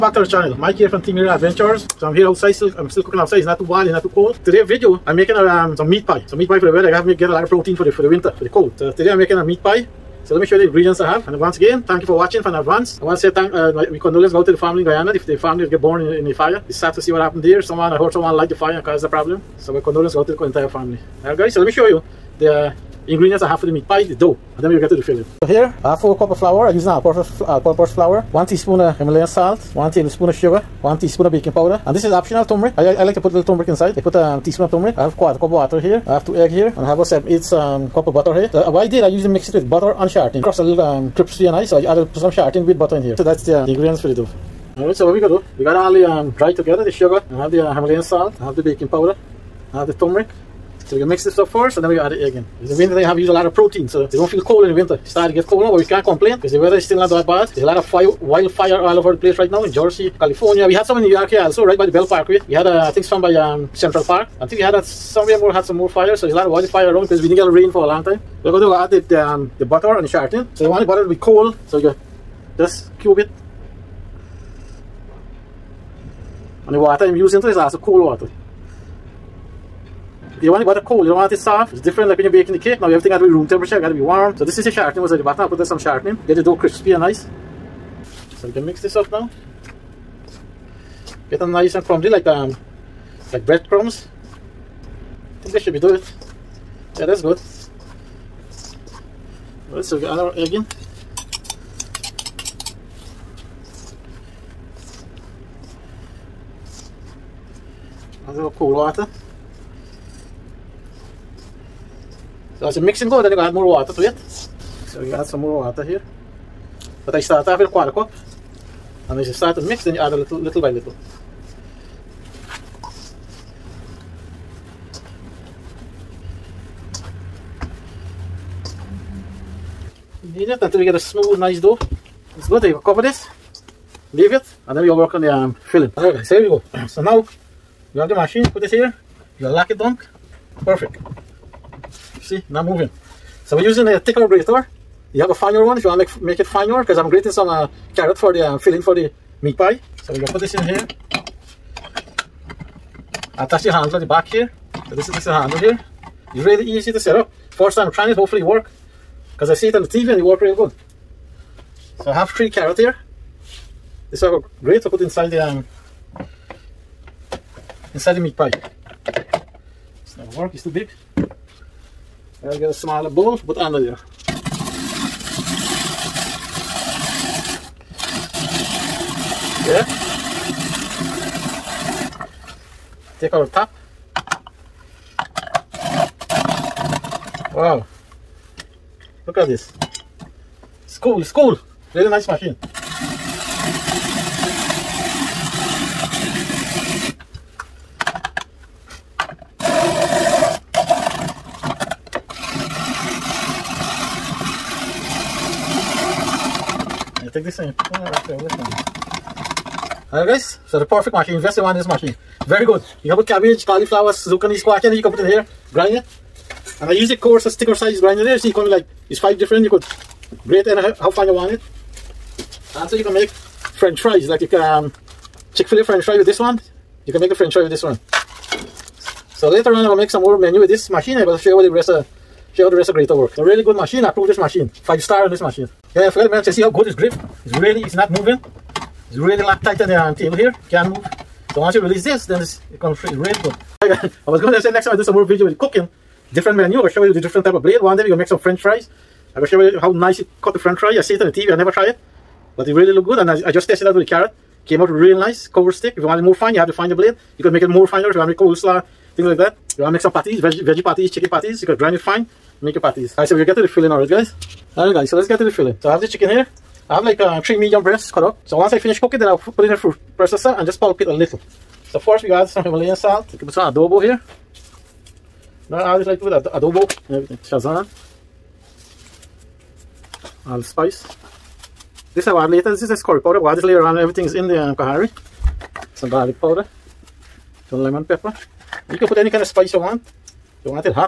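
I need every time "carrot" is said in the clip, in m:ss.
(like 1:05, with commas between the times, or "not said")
2:27, 2:42, 4:14.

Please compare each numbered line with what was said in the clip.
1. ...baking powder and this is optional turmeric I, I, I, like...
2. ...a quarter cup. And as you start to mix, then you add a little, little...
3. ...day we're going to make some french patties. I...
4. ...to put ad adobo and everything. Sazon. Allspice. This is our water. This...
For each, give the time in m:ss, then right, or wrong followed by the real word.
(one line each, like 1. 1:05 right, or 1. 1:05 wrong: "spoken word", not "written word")
1. 0:31 right
2. 1:57 right
3. 4:07 wrong: "fries", not "patties"
4. 4:36 wrong: "later", not "water".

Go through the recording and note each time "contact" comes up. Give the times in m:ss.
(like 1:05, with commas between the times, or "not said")
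not said.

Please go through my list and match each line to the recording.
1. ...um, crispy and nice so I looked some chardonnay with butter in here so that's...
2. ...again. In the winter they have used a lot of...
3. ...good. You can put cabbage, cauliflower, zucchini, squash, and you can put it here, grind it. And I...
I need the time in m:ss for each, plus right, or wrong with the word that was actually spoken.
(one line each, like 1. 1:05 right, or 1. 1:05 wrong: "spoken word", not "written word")
1. 0:40 wrong: "added", not "looked"
2. 0:52 right
3. 3:32 right.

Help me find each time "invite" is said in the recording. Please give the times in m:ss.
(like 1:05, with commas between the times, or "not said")
not said.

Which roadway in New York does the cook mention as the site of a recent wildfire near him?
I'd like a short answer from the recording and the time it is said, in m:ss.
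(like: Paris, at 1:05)
Belt Parkway, at 1:01.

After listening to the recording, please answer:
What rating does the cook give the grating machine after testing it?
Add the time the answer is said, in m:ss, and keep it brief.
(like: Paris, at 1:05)
5 stars, at 3:54.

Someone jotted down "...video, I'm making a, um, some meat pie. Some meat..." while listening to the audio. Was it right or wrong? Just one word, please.
right.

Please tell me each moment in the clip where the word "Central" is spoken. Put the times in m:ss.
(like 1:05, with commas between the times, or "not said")
1:03.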